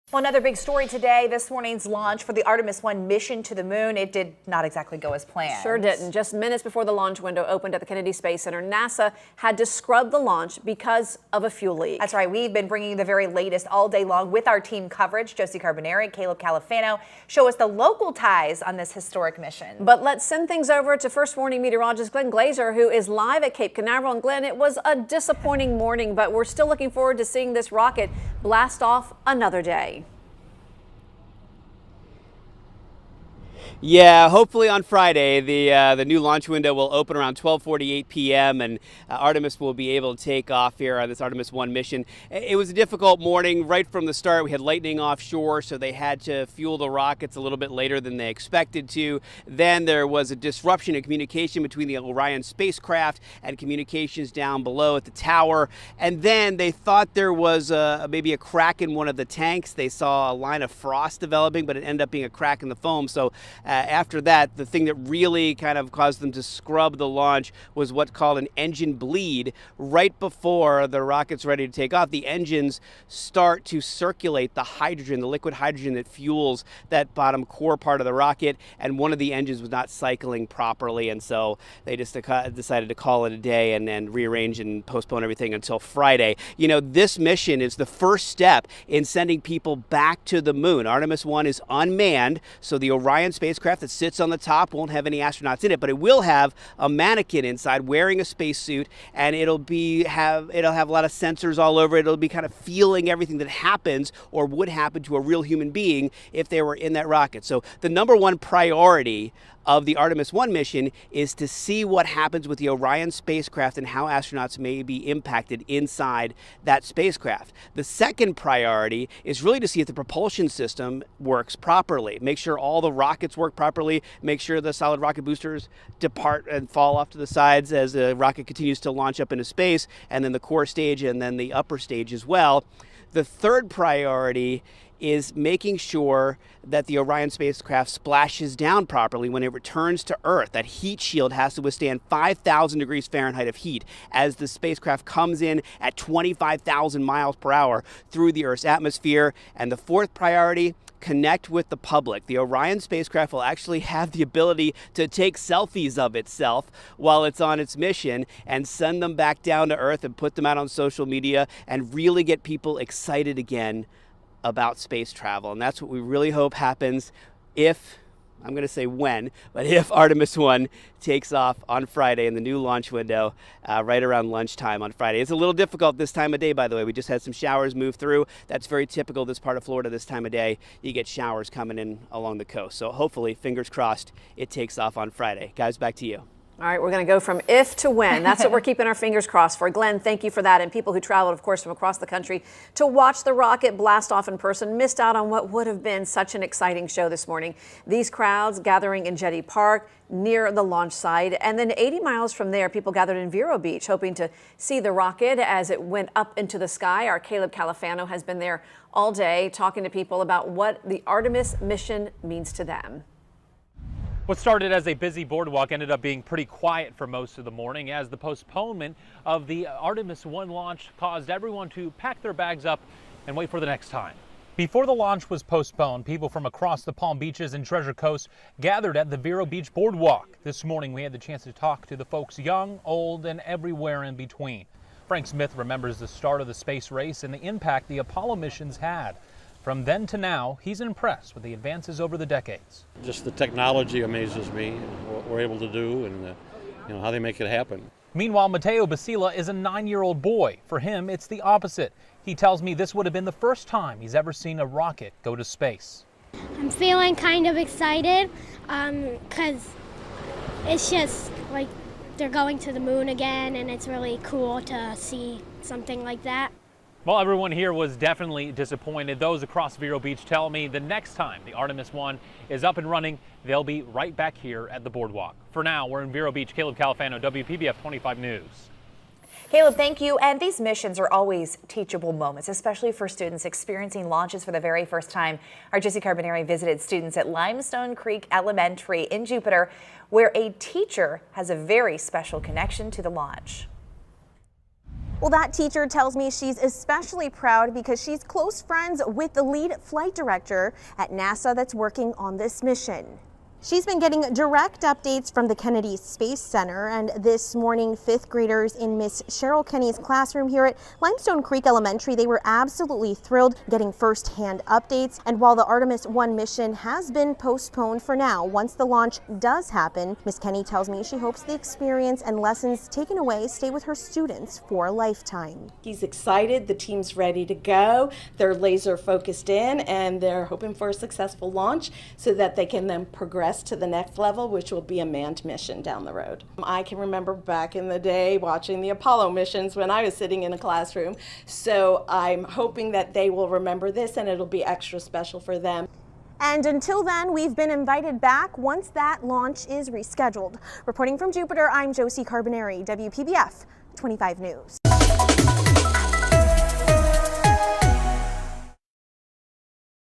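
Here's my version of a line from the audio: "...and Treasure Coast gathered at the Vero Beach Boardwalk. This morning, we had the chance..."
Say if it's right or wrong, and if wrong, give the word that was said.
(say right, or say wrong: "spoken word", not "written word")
right.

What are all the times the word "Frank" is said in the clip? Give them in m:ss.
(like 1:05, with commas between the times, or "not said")
3:55.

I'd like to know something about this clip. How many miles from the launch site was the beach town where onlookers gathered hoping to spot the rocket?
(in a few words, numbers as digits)
80 miles.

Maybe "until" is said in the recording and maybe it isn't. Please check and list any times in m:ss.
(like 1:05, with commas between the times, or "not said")
1:25, 5:46.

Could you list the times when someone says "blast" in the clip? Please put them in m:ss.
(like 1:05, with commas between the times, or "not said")
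0:28, 3:13.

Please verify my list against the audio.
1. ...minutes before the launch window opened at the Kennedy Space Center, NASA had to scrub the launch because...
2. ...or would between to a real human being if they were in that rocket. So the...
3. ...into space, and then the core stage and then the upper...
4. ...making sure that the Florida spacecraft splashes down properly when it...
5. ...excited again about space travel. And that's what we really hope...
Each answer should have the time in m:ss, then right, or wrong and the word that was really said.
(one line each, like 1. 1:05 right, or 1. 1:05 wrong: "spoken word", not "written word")
1. 0:06 right
2. 1:44 wrong: "happen", not "between"
3. 2:09 right
4. 2:15 wrong: "Orion", not "Florida"
5. 2:42 right.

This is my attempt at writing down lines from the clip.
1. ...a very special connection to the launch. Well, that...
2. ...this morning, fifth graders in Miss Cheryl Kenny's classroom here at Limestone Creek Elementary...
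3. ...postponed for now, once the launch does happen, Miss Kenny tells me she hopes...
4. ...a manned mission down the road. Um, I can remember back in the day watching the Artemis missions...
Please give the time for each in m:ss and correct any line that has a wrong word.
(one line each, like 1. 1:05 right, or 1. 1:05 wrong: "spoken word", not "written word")
1. 4:51 right
2. 5:07 right
3. 5:17 right
4. 5:35 wrong: "Apollo", not "Artemis".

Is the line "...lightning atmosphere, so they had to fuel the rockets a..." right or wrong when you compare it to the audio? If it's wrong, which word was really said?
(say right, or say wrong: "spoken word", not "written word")
wrong: "offshore", not "atmosphere".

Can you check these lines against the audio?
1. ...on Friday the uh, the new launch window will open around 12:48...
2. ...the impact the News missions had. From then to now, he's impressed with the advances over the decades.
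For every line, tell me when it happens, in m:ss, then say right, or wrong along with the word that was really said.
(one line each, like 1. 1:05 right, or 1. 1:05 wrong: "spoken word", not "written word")
1. 0:34 right
2. 3:57 wrong: "Apollo", not "News".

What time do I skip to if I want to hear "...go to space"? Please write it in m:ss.
4:15.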